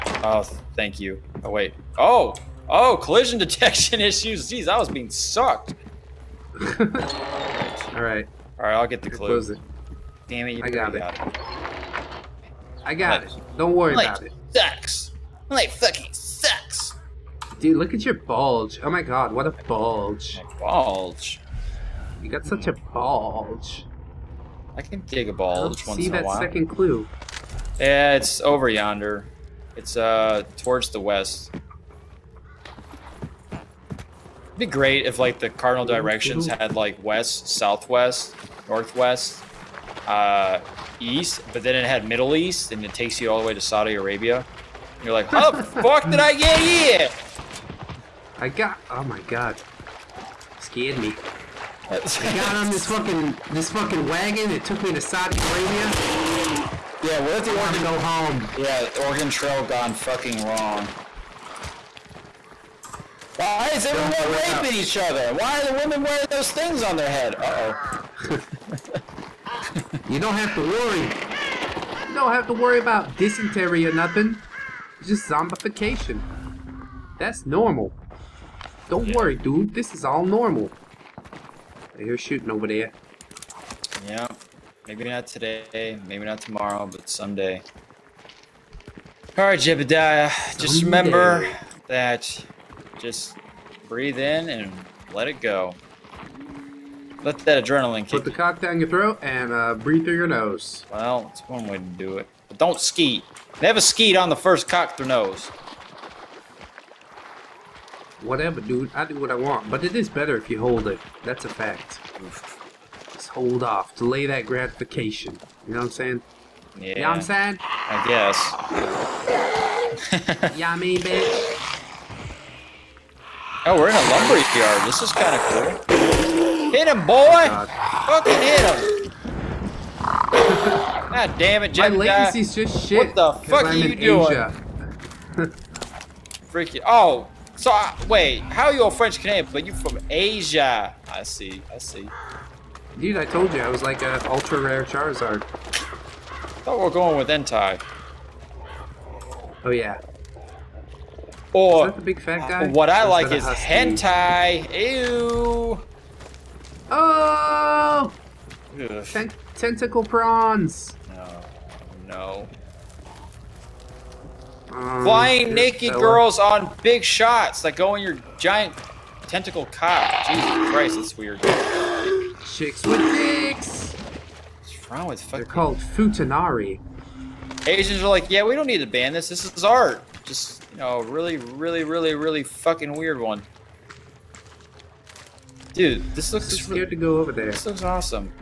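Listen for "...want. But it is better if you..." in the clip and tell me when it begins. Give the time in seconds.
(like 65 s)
109 s.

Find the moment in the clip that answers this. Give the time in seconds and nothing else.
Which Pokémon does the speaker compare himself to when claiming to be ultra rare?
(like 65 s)
144 s.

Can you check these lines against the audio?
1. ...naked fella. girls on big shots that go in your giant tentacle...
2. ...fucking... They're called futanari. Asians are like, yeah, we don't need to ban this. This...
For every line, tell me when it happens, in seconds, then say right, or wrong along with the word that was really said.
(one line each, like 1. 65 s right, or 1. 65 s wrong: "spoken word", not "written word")
1. 165 s right
2. 175 s right.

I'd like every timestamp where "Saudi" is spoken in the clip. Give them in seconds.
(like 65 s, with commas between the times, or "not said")
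43 s, 55 s.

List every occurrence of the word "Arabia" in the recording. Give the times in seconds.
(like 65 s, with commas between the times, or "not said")
43 s, 55 s.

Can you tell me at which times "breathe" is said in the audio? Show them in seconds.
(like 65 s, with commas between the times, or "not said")
93 s, 99 s.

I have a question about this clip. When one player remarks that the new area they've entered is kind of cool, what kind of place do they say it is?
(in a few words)
Lumber yard.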